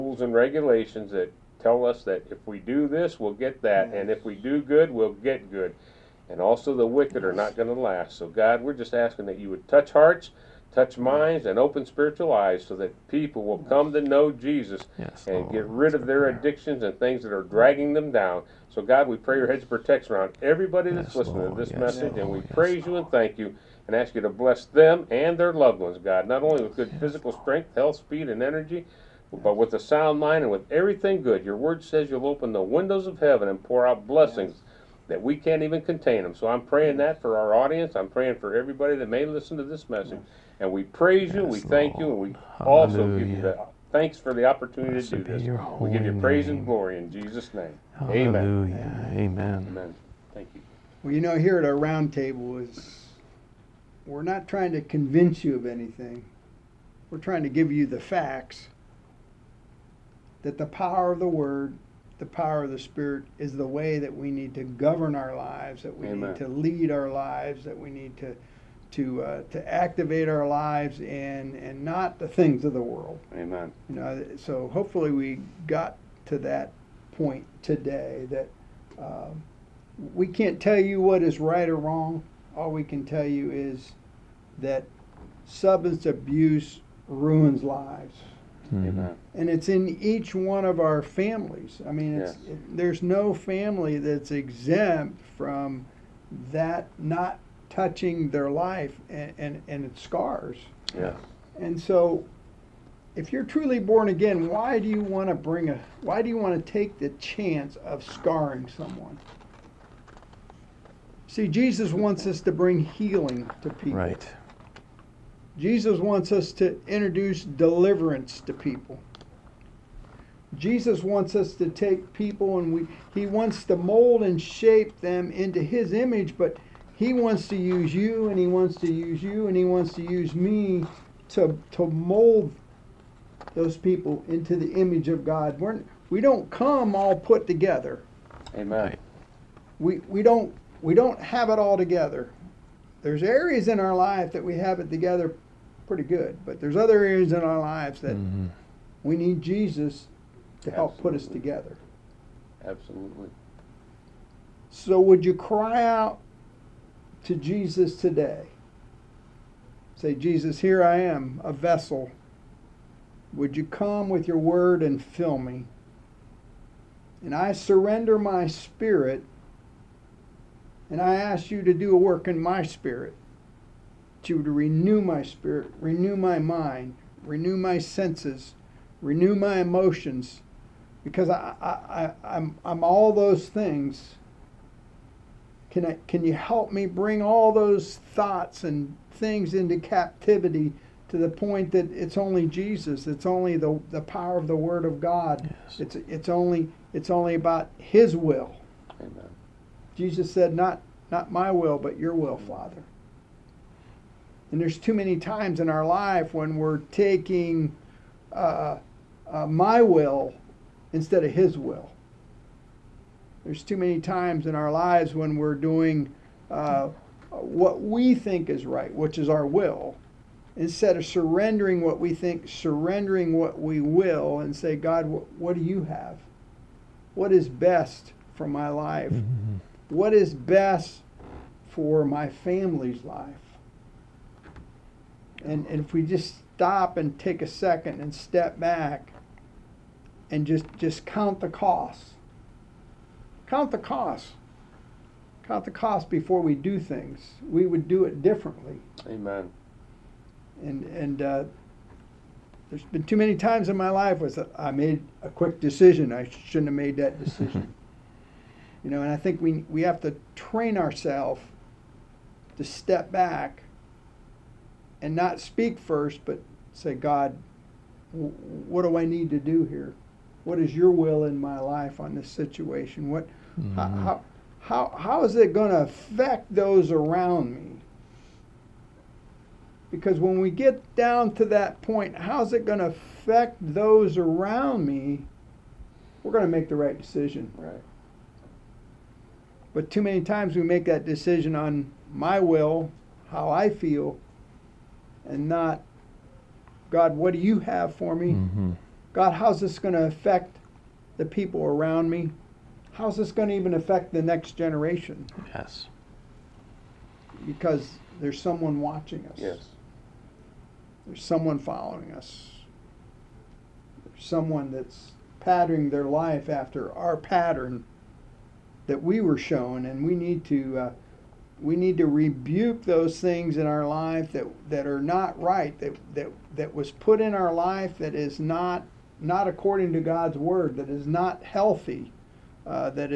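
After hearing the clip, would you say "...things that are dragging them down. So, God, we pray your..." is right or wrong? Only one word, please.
right.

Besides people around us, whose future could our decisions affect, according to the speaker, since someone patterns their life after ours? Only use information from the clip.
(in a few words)
the next generation.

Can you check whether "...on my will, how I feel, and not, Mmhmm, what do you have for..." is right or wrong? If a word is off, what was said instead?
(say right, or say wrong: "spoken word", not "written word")
wrong: "God", not "Mmhmm".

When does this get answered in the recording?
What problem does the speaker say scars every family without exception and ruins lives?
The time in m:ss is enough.
1:25.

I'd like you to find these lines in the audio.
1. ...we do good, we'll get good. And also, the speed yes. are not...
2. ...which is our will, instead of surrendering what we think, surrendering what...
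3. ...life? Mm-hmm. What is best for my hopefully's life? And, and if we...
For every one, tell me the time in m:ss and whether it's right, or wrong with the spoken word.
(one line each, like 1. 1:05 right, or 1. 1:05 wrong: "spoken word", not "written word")
1. 0:04 wrong: "wicked", not "speed"
2. 3:38 right
3. 3:48 wrong: "family", not "hopefully".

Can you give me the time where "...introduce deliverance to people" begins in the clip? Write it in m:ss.
1:56.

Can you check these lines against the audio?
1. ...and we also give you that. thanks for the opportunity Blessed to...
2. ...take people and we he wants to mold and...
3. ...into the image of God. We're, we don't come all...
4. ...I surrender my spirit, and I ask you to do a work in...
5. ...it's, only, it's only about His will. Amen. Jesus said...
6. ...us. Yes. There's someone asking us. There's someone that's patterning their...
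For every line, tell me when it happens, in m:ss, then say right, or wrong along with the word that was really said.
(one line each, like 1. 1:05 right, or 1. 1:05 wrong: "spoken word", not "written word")
1. 0:42 right
2. 2:01 right
3. 2:14 right
4. 2:47 right
5. 3:16 right
6. 5:09 wrong: "following", not "asking".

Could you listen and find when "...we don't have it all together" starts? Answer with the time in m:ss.
2:20.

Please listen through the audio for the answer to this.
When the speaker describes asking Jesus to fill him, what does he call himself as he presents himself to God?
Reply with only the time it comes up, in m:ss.
2:41.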